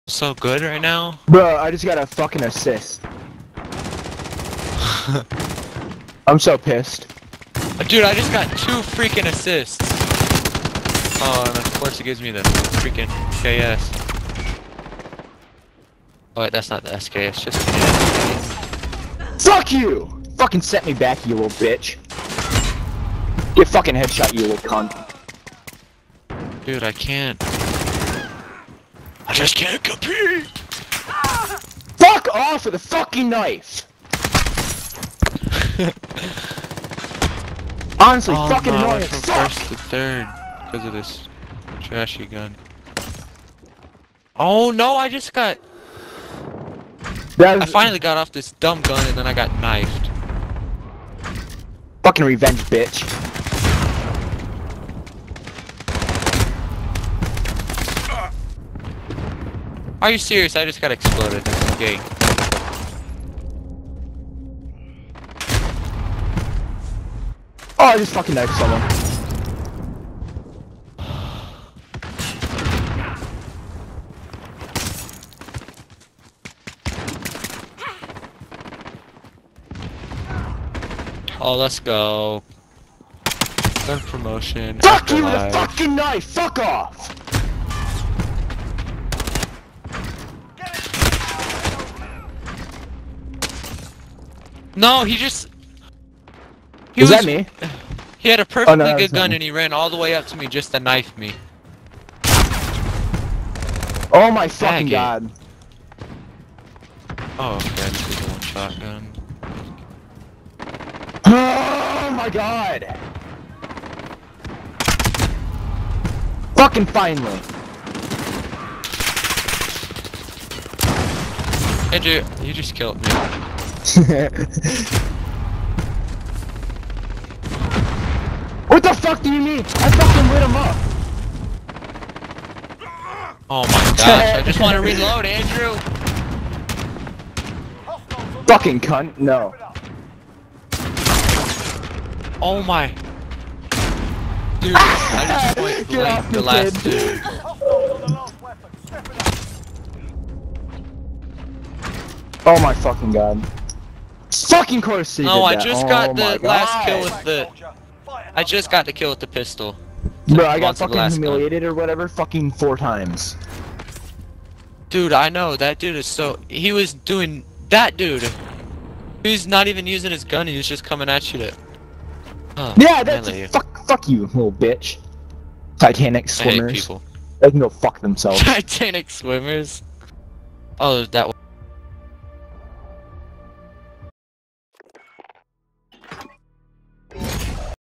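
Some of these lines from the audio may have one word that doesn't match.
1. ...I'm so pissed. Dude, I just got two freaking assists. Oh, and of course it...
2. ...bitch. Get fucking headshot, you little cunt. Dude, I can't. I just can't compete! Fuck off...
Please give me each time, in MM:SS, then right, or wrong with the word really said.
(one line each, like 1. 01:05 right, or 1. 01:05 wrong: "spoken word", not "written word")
1. 00:06 right
2. 00:21 right.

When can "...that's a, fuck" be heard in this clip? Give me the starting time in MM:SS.
02:53.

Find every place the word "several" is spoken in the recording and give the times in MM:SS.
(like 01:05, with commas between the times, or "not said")
not said.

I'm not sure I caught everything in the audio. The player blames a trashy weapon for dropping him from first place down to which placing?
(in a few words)
third.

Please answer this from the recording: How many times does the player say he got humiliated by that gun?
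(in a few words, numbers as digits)
4.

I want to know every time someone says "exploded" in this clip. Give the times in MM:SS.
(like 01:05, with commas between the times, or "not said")
01:00.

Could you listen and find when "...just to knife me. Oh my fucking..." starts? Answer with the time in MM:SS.
01:40.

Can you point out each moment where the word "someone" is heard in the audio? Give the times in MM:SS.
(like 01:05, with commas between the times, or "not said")
01:08.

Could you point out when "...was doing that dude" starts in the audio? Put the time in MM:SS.
02:46.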